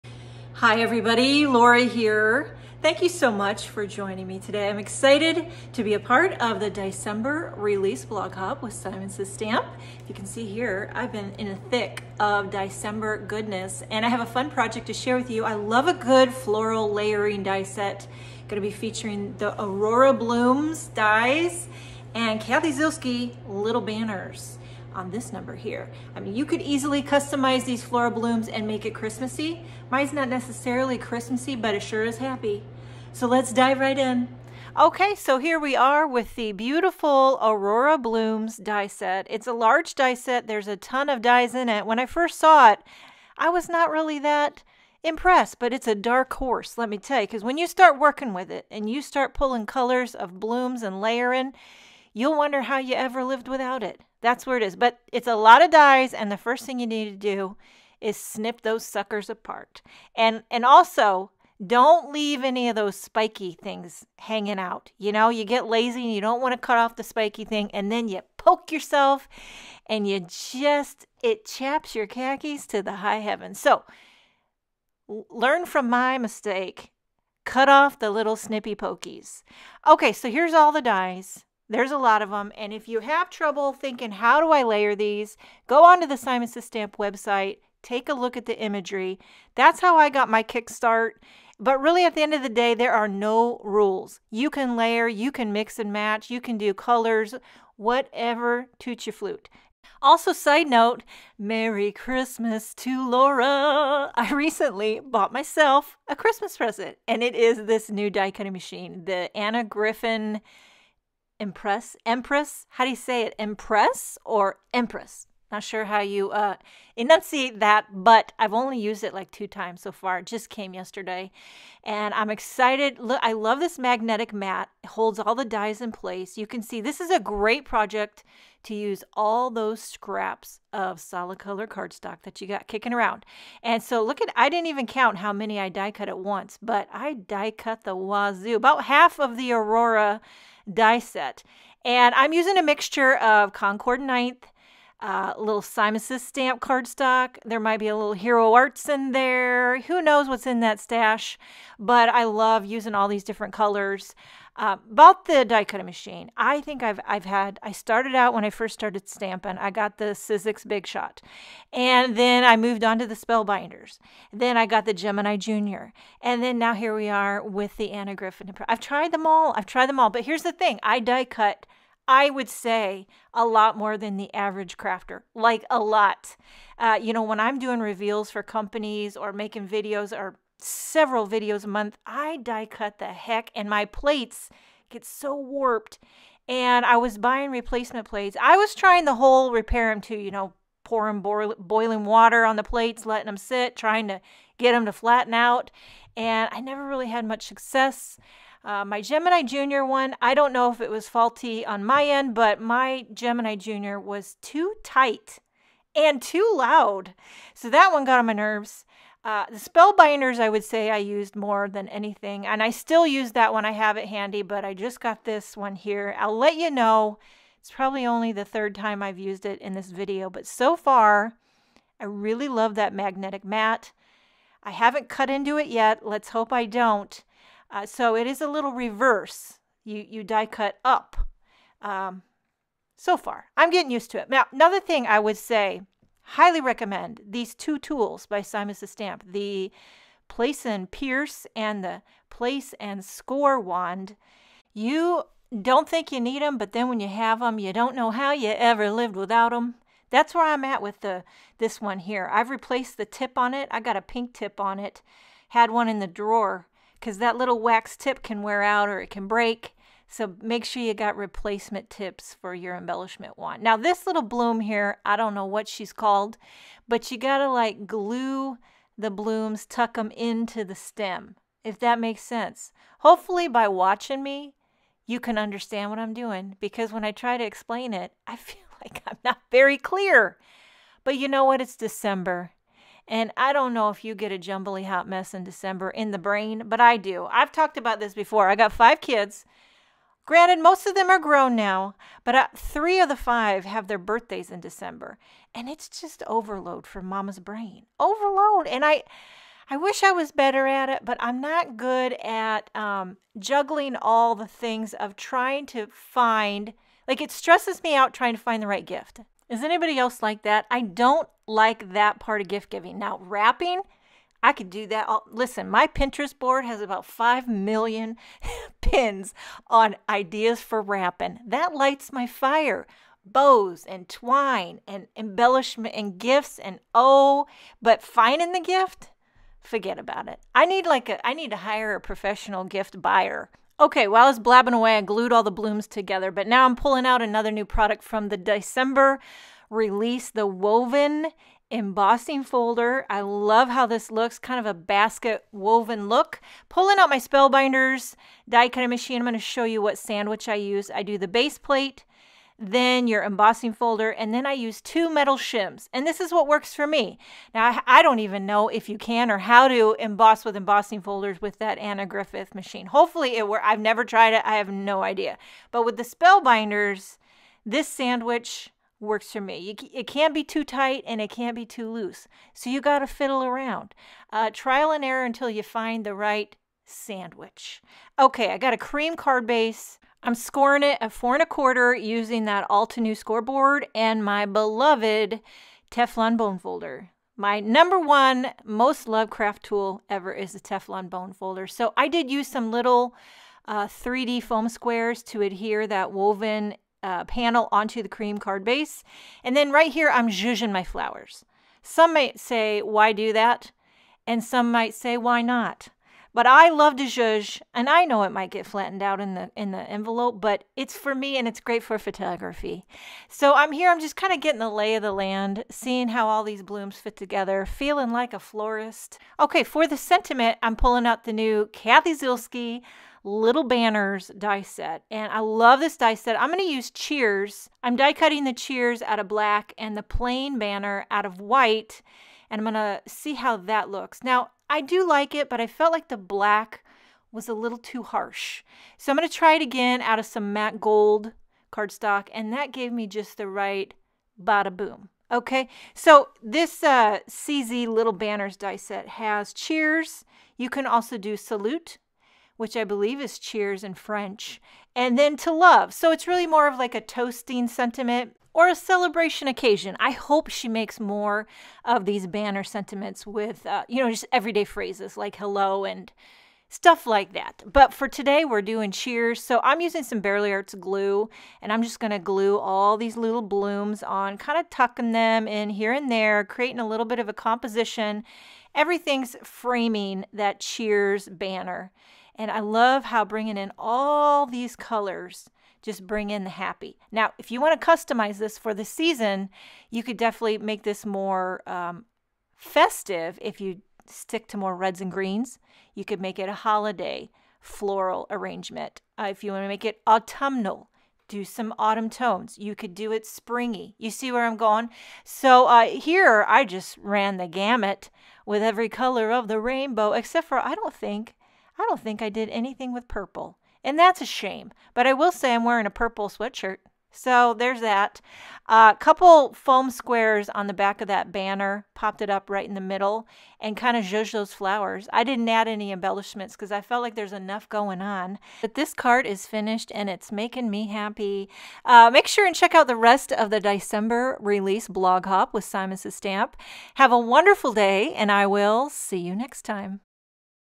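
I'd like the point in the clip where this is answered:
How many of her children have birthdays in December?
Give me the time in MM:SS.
04:52.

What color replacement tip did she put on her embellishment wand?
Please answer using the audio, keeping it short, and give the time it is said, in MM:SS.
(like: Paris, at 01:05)
Pink, at 04:14.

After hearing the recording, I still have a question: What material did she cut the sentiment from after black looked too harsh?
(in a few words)
Matte gold cardstock.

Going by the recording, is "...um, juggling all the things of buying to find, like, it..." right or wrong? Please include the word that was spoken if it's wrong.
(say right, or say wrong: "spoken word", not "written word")
wrong: "trying", not "buying".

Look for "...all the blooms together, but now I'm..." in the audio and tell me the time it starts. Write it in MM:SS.
05:35.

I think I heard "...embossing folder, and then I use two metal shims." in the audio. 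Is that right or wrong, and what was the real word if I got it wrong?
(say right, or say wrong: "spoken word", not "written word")
right.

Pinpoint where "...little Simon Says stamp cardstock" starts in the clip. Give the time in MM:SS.
02:25.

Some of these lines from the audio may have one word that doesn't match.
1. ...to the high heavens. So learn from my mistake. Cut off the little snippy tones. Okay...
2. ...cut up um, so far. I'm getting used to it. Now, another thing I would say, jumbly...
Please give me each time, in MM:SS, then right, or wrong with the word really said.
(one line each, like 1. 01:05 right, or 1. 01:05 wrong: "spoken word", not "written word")
1. 01:12 wrong: "pokies", not "tones"
2. 03:50 wrong: "highly", not "jumbly".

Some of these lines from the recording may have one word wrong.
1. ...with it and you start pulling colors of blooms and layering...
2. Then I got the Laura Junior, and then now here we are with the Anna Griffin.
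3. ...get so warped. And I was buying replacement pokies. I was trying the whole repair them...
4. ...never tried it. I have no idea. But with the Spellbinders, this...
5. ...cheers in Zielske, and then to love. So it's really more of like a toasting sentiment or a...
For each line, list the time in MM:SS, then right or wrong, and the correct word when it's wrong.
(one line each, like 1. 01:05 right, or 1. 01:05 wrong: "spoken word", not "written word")
1. 00:48 right
2. 02:44 wrong: "Gemini", not "Laura"
3. 03:04 wrong: "plates", not "pokies"
4. 06:03 right
5. 07:33 wrong: "French", not "Zielske".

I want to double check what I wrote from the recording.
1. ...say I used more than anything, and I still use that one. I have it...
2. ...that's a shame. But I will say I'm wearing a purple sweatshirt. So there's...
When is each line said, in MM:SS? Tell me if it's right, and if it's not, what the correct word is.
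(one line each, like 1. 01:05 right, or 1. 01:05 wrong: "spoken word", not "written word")
1. 03:30 right
2. 08:33 right.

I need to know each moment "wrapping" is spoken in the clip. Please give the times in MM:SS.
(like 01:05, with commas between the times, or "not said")
05:13, 05:20.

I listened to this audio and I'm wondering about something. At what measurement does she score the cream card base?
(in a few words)
4 1/4.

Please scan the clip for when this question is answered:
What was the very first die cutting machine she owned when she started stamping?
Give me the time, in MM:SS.
02:40.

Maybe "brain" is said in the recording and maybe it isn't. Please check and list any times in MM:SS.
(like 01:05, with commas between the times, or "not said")
04:46, 04:57.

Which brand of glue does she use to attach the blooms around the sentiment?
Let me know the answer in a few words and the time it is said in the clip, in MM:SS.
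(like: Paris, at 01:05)
Bearly Arts, at 07:50.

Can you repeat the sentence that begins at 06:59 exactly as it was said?
Okay, for the sentiment, I'm pulling out the new Cathy Zielske little banners die set.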